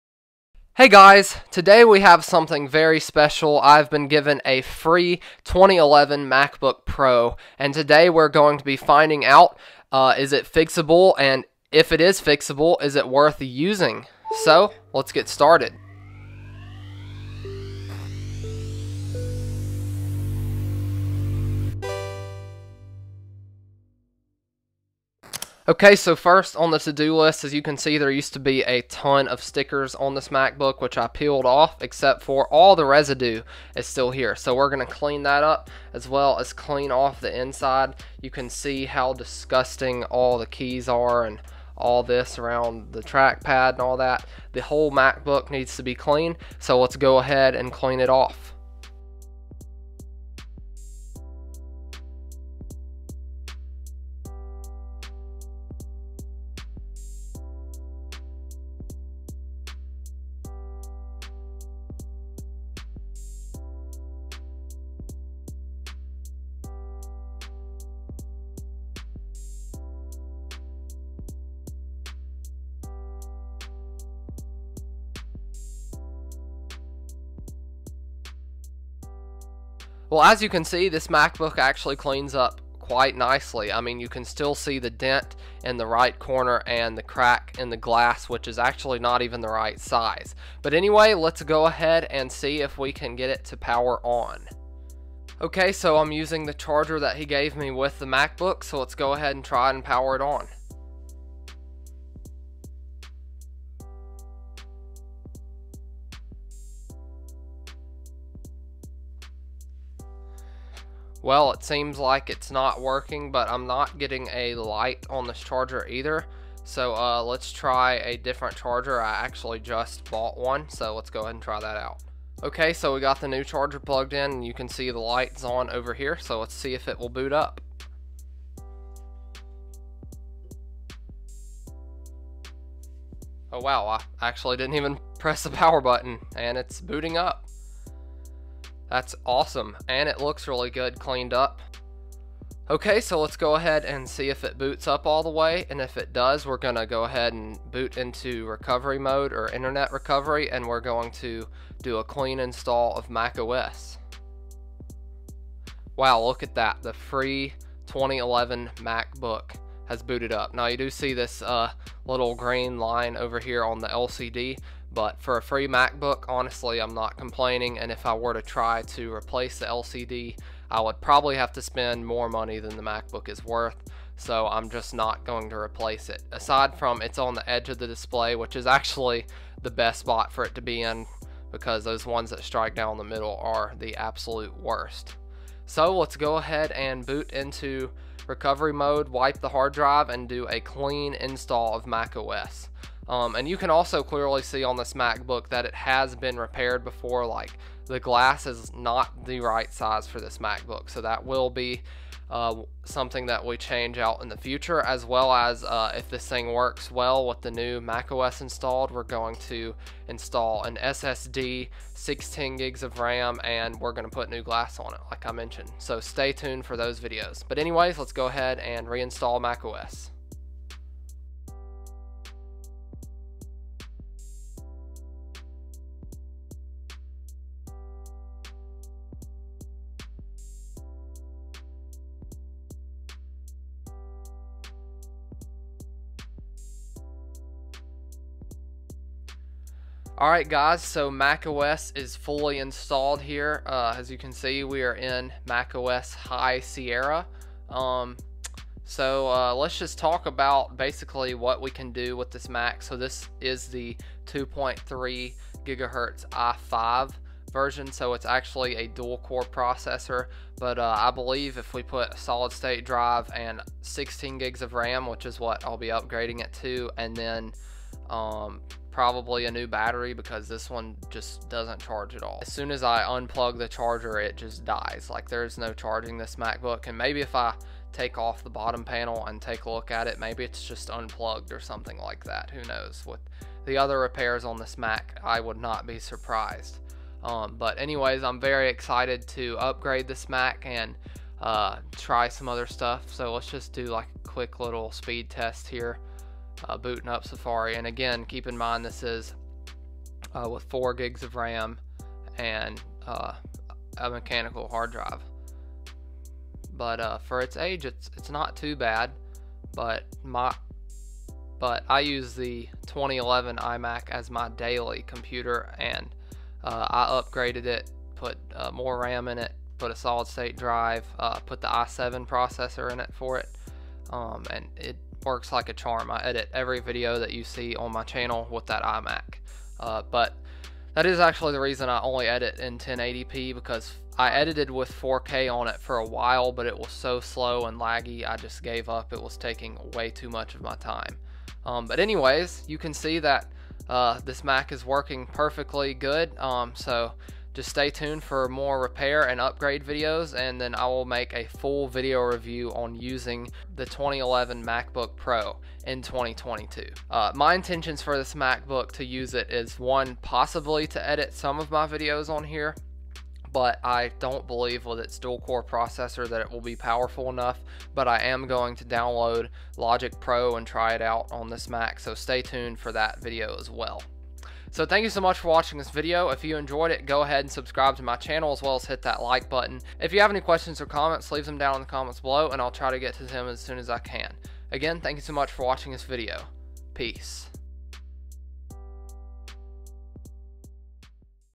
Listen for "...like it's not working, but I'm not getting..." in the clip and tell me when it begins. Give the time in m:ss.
1:51.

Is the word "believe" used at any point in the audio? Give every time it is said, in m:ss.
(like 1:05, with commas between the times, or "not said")
4:21, 6:04.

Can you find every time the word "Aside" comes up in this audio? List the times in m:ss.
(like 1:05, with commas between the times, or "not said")
2:56.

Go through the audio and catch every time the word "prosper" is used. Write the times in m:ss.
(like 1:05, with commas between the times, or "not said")
not said.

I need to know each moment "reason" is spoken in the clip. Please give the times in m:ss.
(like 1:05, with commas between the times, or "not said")
5:31.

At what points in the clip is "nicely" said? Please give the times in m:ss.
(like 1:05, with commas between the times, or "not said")
1:23.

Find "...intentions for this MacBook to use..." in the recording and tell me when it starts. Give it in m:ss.
5:57.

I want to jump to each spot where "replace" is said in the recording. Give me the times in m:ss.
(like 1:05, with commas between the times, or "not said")
2:49, 2:55.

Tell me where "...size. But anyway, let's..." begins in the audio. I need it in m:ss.
1:29.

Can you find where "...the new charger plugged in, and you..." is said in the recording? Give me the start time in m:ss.
2:03.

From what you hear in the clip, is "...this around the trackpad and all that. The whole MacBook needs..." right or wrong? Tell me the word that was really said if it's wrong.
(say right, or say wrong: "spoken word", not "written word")
right.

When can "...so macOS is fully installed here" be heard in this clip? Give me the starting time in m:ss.
4:00.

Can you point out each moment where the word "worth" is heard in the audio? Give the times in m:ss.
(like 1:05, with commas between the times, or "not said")
0:13, 2:53.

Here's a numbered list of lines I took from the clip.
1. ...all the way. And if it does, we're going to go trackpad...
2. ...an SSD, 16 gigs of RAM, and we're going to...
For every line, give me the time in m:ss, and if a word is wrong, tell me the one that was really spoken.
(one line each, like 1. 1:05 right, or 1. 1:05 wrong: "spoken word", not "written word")
1. 2:25 wrong: "ahead", not "trackpad"
2. 3:30 right.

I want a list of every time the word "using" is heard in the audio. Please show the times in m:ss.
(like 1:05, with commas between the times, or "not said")
0:13, 1:36, 5:52.